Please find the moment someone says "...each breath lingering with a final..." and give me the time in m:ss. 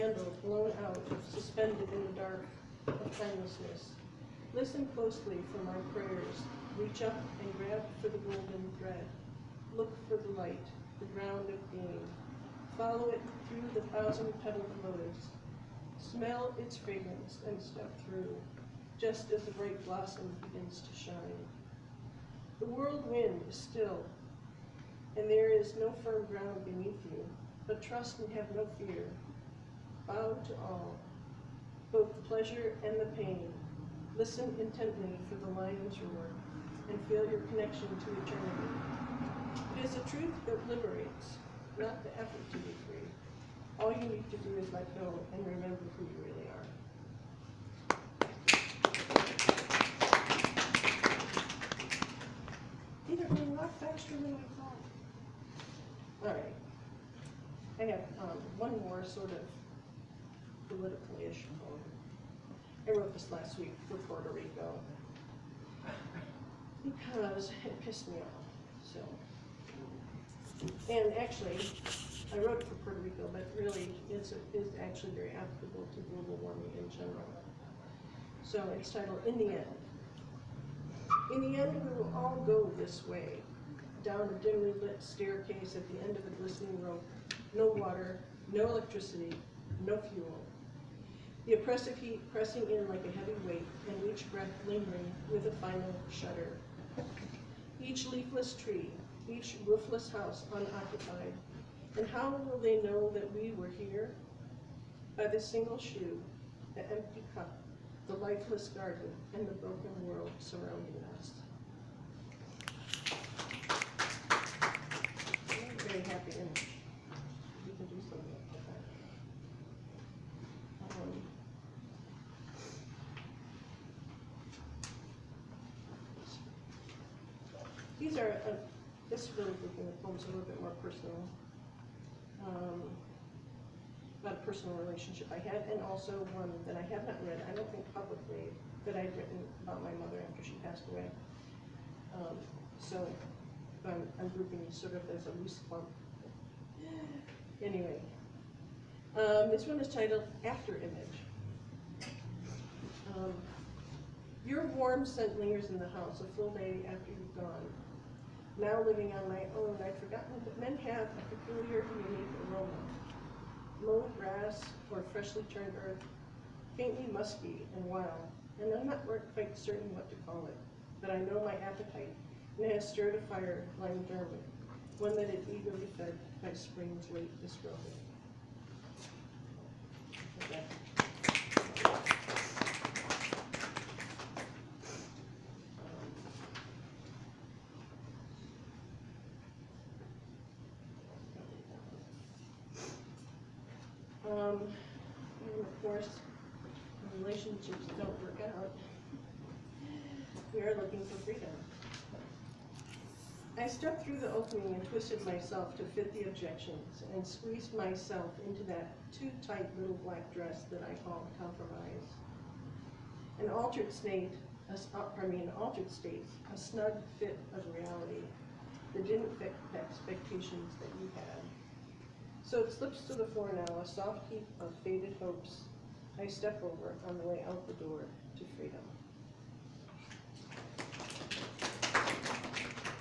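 1:34.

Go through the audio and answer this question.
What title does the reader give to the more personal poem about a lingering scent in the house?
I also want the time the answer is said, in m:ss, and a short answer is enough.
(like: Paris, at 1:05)
After Image, at 2:30.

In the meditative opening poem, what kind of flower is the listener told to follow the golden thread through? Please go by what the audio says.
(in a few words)
thousand-petaled lotus.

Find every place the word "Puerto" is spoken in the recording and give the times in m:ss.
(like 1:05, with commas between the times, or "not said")
1:03, 1:12.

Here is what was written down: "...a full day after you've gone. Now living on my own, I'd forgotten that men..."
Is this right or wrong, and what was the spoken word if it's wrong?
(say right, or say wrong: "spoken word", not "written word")
right.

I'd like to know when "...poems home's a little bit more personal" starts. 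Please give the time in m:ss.
2:10.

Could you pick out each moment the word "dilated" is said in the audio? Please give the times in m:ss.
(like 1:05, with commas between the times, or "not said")
not said.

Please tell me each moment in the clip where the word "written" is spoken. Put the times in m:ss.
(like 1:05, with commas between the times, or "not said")
2:19.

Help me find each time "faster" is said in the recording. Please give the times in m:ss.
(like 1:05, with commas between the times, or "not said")
0:53.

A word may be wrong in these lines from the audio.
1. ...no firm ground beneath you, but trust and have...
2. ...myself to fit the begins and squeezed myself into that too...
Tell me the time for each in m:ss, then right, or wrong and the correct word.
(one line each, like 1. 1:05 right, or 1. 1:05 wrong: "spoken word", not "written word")
1. 0:25 right
2. 3:25 wrong: "objections", not "begins".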